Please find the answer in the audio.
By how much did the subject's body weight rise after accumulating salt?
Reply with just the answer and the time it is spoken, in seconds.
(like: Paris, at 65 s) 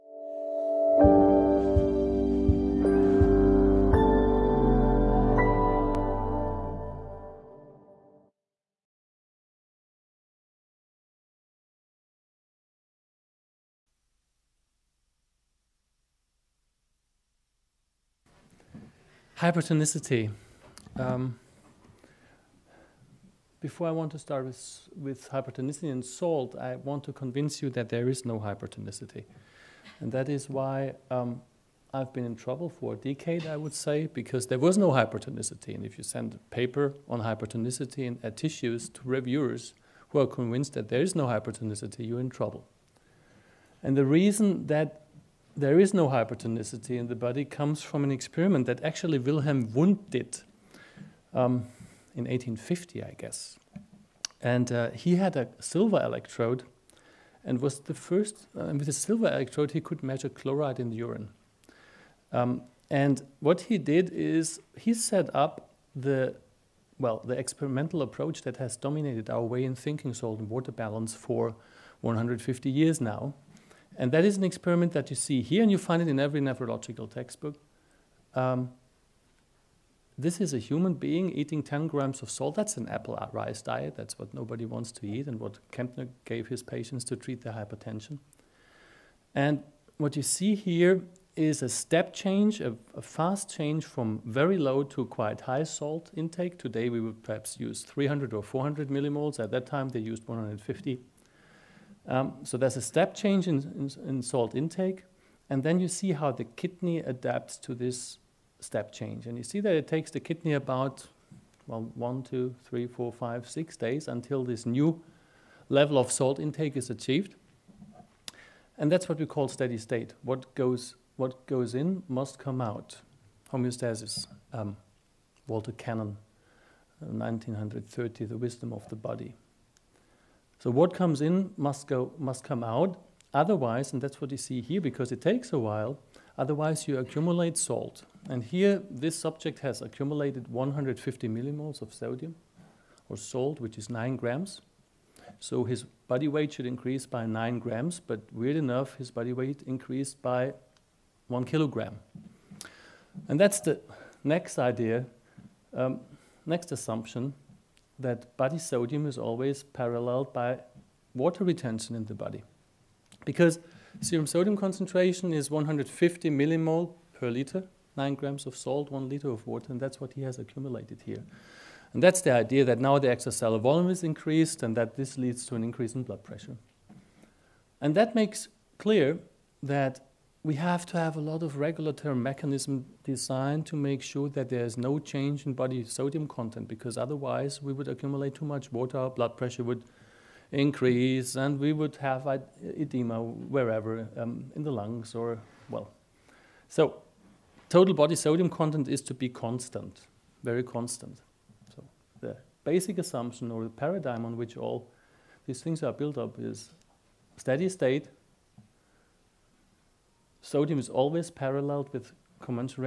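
1 kilogram, at 151 s.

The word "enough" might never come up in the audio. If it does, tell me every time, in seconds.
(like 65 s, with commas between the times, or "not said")
148 s.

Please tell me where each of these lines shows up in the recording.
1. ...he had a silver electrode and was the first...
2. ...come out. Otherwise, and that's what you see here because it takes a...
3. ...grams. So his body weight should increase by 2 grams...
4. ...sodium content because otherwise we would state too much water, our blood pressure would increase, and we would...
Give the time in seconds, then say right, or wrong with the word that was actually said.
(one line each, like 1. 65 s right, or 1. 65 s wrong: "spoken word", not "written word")
1. 54 s right
2. 132 s right
3. 144 s wrong: "9", not "2"
4. 185 s wrong: "accumulate", not "state".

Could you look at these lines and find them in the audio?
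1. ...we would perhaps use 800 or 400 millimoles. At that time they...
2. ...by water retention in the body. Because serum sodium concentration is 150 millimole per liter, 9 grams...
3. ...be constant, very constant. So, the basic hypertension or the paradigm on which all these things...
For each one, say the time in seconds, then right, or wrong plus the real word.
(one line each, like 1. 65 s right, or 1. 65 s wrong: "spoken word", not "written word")
1. 96 s wrong: "300", not "800"
2. 160 s right
3. 199 s wrong: "assumption", not "hypertension".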